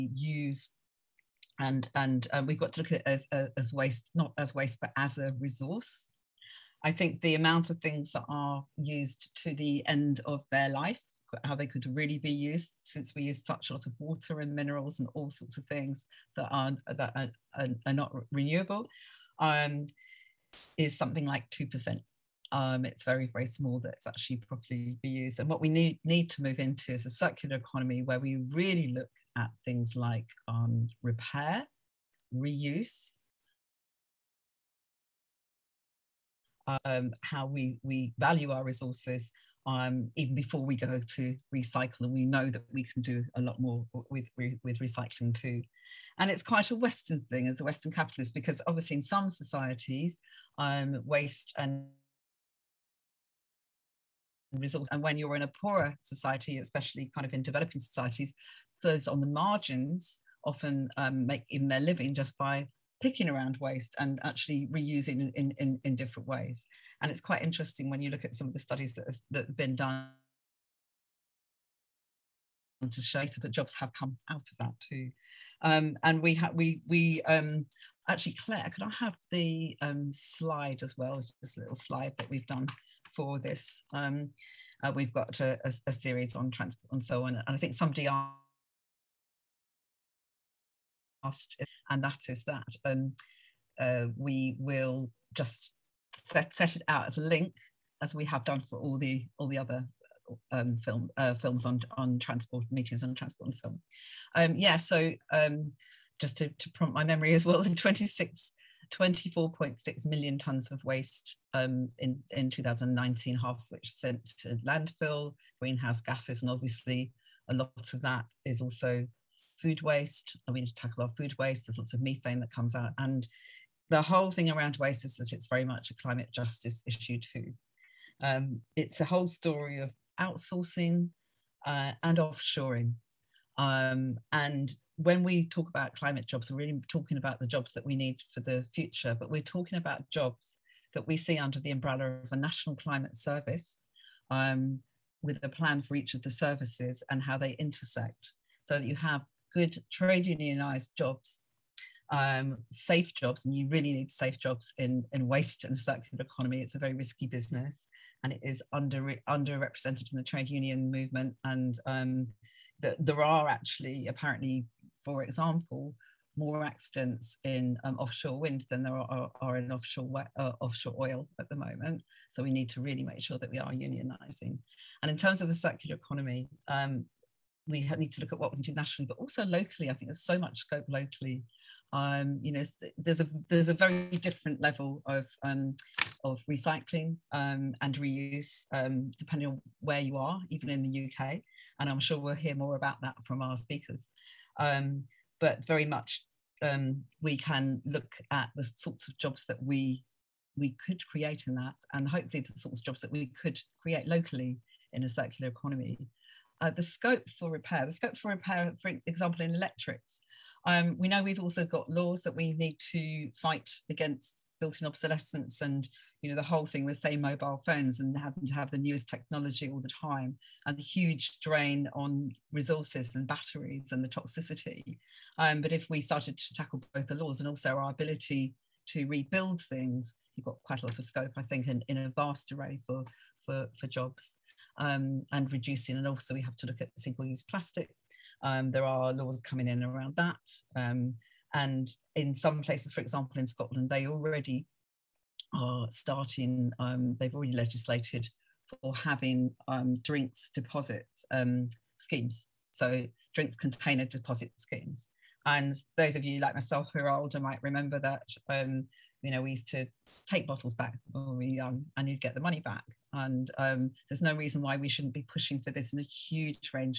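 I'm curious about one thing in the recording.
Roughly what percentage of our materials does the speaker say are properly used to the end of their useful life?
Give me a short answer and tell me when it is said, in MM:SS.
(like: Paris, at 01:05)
2%, at 00:21.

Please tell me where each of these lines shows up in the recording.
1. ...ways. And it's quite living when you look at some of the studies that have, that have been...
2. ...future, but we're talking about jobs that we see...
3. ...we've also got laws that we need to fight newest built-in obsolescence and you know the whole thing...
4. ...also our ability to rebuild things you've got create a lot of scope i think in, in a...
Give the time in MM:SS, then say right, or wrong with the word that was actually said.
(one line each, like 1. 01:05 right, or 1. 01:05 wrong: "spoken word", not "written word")
1. 01:06 wrong: "interesting", not "living"
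2. 02:18 right
3. 03:31 wrong: "against", not "newest"
4. 03:47 wrong: "quite", not "create".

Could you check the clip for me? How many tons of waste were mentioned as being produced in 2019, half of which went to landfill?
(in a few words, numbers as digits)
24.6 million tons.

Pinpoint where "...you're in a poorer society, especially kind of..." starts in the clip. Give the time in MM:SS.
00:55.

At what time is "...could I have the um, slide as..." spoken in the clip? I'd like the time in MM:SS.
01:18.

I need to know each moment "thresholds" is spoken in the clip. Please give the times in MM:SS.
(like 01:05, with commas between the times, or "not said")
not said.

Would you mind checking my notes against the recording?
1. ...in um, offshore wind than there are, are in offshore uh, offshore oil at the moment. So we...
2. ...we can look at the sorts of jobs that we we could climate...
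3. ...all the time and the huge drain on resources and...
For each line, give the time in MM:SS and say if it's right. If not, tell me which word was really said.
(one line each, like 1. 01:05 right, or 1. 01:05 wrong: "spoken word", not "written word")
1. 02:47 right
2. 03:17 wrong: "create", not "climate"
3. 03:39 right.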